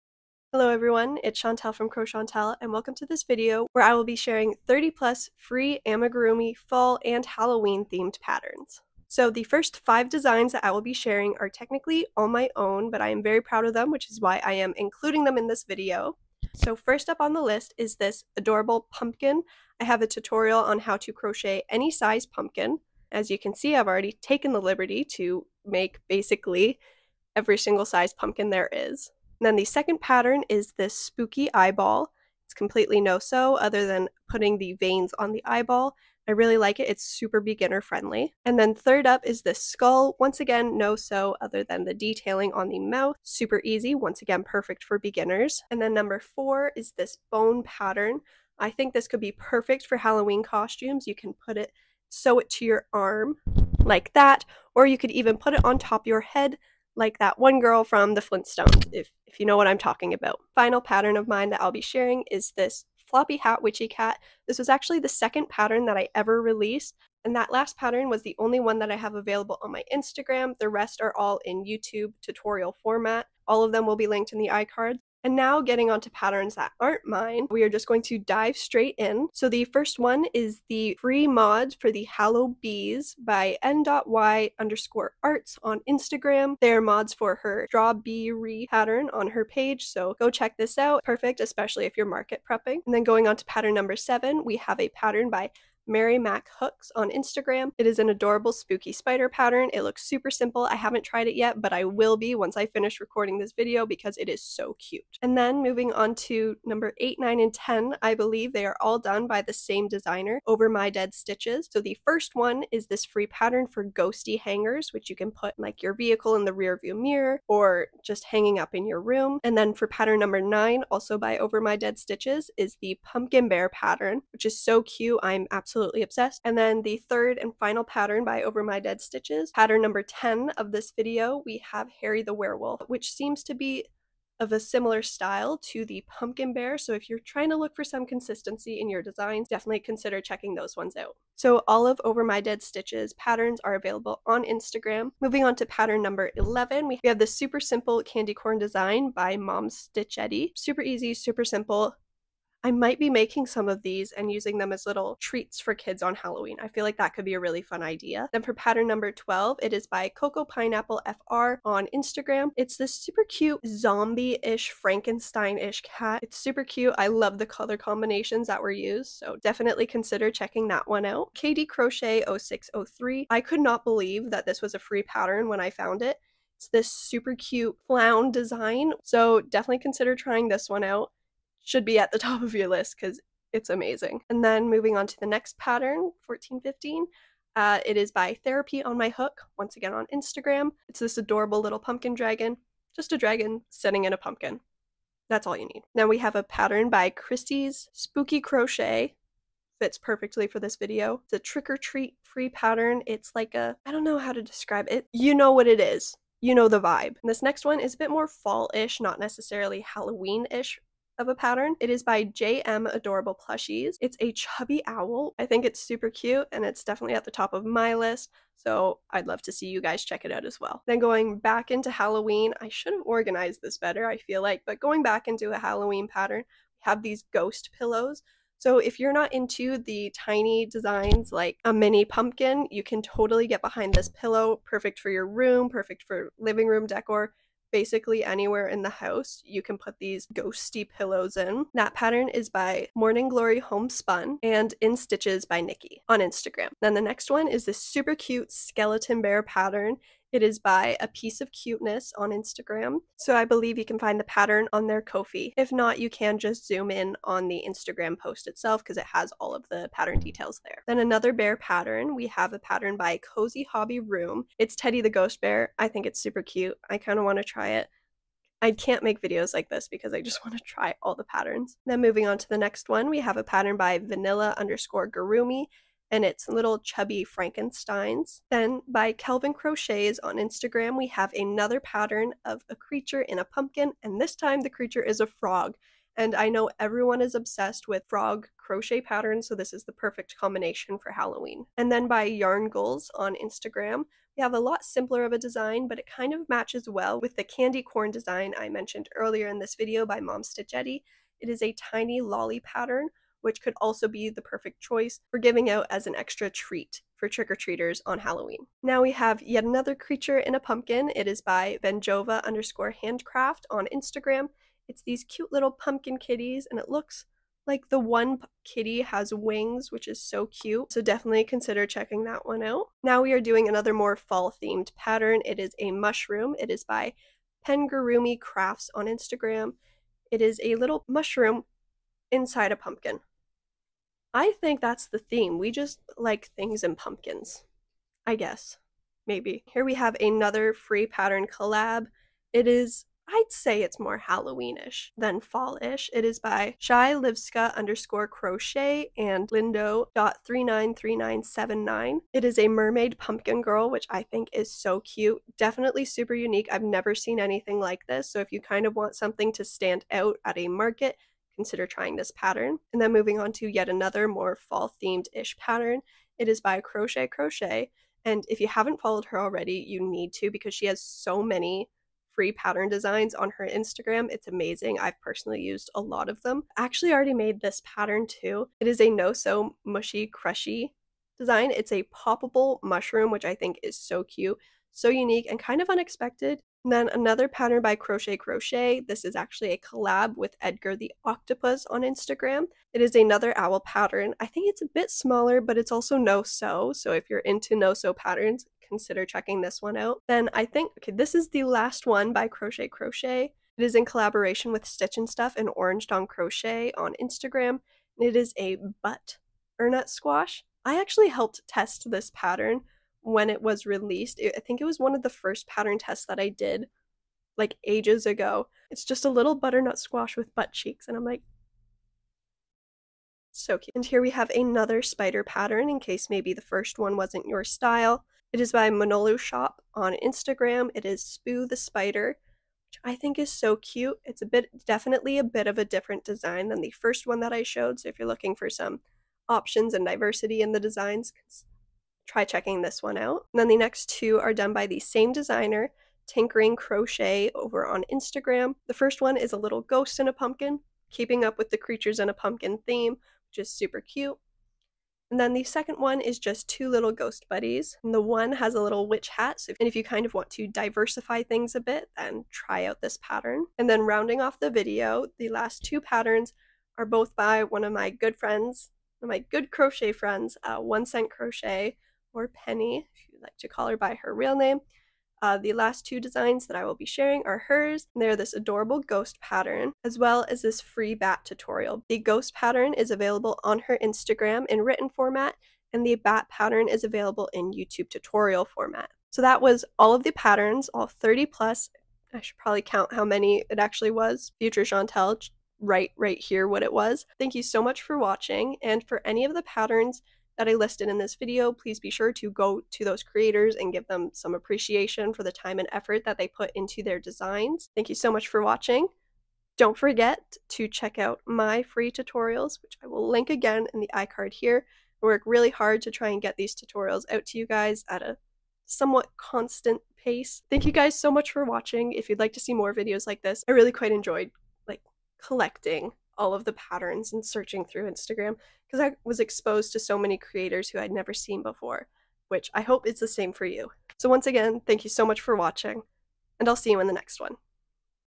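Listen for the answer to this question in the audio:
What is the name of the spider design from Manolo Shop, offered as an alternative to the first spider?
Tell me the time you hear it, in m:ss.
7:11.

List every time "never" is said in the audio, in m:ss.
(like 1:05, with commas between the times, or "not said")
5:56, 8:51.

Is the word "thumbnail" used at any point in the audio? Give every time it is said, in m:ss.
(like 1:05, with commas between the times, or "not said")
not said.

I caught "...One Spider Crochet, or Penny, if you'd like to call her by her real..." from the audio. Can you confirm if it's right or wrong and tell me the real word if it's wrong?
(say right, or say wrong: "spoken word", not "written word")
wrong: "Cent", not "Spider".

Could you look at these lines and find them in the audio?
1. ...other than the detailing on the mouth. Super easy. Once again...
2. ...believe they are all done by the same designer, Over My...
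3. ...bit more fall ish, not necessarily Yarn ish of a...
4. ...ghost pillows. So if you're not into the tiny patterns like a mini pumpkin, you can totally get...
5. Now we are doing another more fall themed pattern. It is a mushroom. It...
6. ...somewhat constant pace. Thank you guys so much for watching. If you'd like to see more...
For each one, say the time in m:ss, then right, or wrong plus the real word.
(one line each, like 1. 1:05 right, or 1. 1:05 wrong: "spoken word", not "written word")
1. 0:41 right
2. 1:48 right
3. 3:27 wrong: "Halloween", not "Yarn"
4. 3:47 wrong: "designs", not "patterns"
5. 5:23 right
6. 8:38 right.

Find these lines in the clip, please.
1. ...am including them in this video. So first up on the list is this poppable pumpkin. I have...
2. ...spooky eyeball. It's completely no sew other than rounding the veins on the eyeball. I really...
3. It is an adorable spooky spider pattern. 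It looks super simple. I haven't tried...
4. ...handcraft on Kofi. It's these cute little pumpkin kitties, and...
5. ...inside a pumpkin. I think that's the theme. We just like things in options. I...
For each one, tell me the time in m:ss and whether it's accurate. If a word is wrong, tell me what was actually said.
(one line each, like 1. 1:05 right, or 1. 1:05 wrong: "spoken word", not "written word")
1. 0:14 wrong: "adorable", not "poppable"
2. 0:30 wrong: "putting", not "rounding"
3. 1:37 right
4. 5:12 wrong: "Instagram", not "Kofi"
5. 5:32 wrong: "pumpkins", not "options".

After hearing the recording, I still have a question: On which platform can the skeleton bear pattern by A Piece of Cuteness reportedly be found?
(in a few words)
Ko-fi.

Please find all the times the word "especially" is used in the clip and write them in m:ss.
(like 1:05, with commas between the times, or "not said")
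1:31.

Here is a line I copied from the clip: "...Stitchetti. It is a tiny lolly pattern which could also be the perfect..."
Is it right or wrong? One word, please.
right.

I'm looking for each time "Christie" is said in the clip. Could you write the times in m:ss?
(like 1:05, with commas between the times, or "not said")
3:17.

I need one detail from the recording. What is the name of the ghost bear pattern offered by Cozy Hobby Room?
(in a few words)
Teddy.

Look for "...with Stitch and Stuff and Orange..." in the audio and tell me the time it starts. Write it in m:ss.
6:44.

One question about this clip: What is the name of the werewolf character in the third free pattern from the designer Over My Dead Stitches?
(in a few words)
Harry.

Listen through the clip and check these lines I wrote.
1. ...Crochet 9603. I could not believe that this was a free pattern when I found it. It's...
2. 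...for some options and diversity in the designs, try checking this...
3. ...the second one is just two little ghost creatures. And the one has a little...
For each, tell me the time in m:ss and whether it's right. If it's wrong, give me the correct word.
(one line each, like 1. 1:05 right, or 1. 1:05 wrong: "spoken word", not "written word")
1. 2:51 wrong: "0603", not "9603"
2. 7:18 right
3. 7:35 wrong: "buddies", not "creatures".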